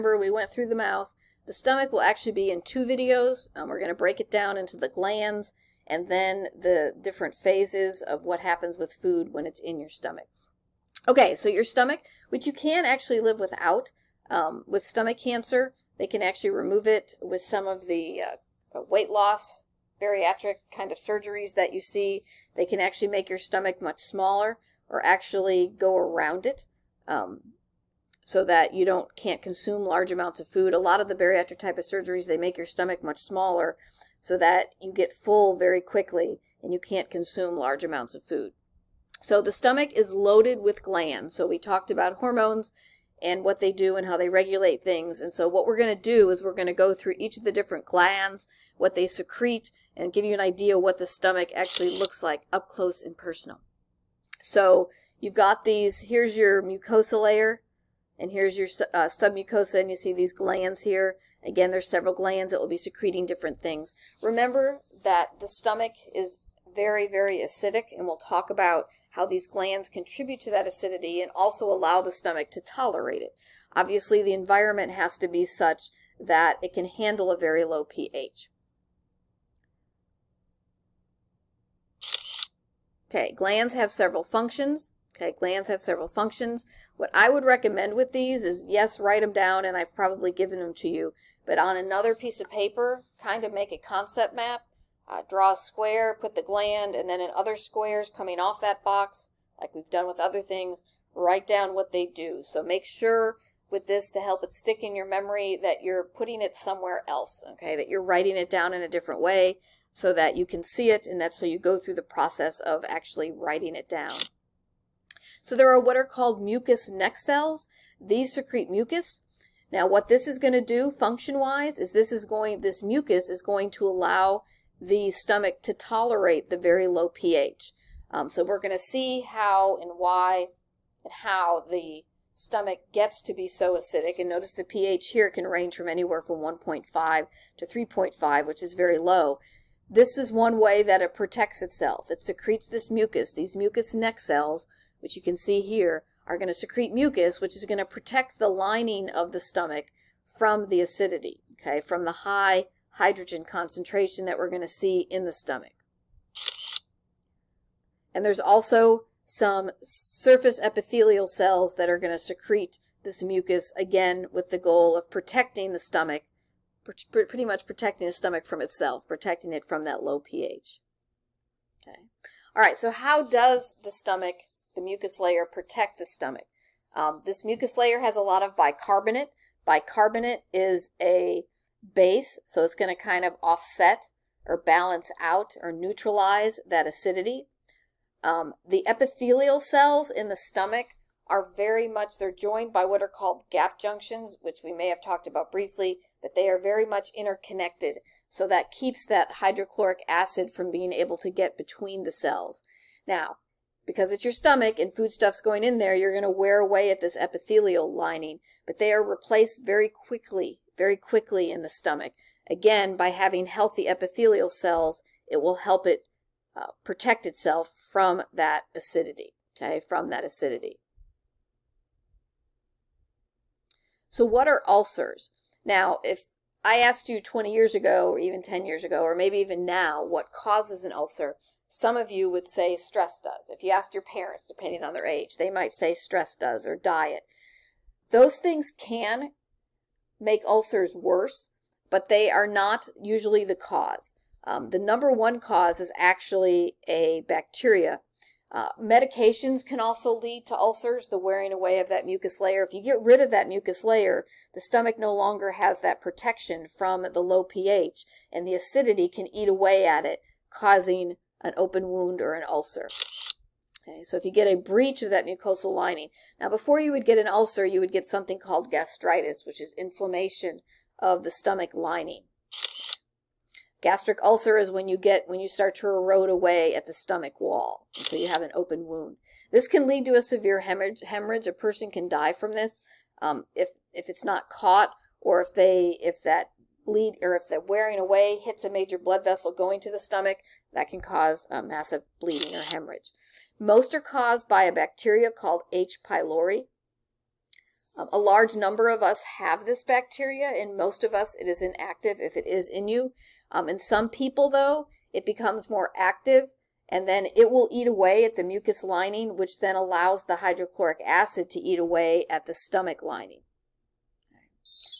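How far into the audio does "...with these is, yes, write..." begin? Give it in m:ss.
1:27.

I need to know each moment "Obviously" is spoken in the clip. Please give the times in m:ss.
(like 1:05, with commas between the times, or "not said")
1:13.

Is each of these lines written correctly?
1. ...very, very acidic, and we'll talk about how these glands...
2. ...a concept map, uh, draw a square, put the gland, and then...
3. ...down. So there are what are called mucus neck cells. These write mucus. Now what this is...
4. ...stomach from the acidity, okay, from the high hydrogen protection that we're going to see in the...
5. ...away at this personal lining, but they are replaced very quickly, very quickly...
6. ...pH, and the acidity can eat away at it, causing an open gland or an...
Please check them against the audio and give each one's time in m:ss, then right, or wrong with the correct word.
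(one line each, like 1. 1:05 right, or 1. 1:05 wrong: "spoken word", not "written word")
1. 1:06 right
2. 1:33 right
3. 1:53 wrong: "secrete", not "write"
4. 2:29 wrong: "concentration", not "protection"
5. 3:26 wrong: "epithelial", not "personal"
6. 4:17 wrong: "wound", not "gland".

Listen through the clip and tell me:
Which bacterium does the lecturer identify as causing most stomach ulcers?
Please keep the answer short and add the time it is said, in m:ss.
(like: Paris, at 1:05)
H. pylori, at 4:55.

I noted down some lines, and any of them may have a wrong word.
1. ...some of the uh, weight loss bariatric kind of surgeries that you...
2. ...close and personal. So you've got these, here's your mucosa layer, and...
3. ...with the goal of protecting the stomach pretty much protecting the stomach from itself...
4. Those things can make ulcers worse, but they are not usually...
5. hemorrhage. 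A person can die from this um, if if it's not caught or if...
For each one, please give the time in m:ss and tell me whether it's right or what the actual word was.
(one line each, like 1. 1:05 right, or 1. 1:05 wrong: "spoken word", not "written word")
1. 0:17 right
2. 0:52 right
3. 2:44 right
4. 3:58 right
5. 4:41 right.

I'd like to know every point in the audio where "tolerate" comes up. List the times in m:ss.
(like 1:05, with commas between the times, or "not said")
1:12, 2:05.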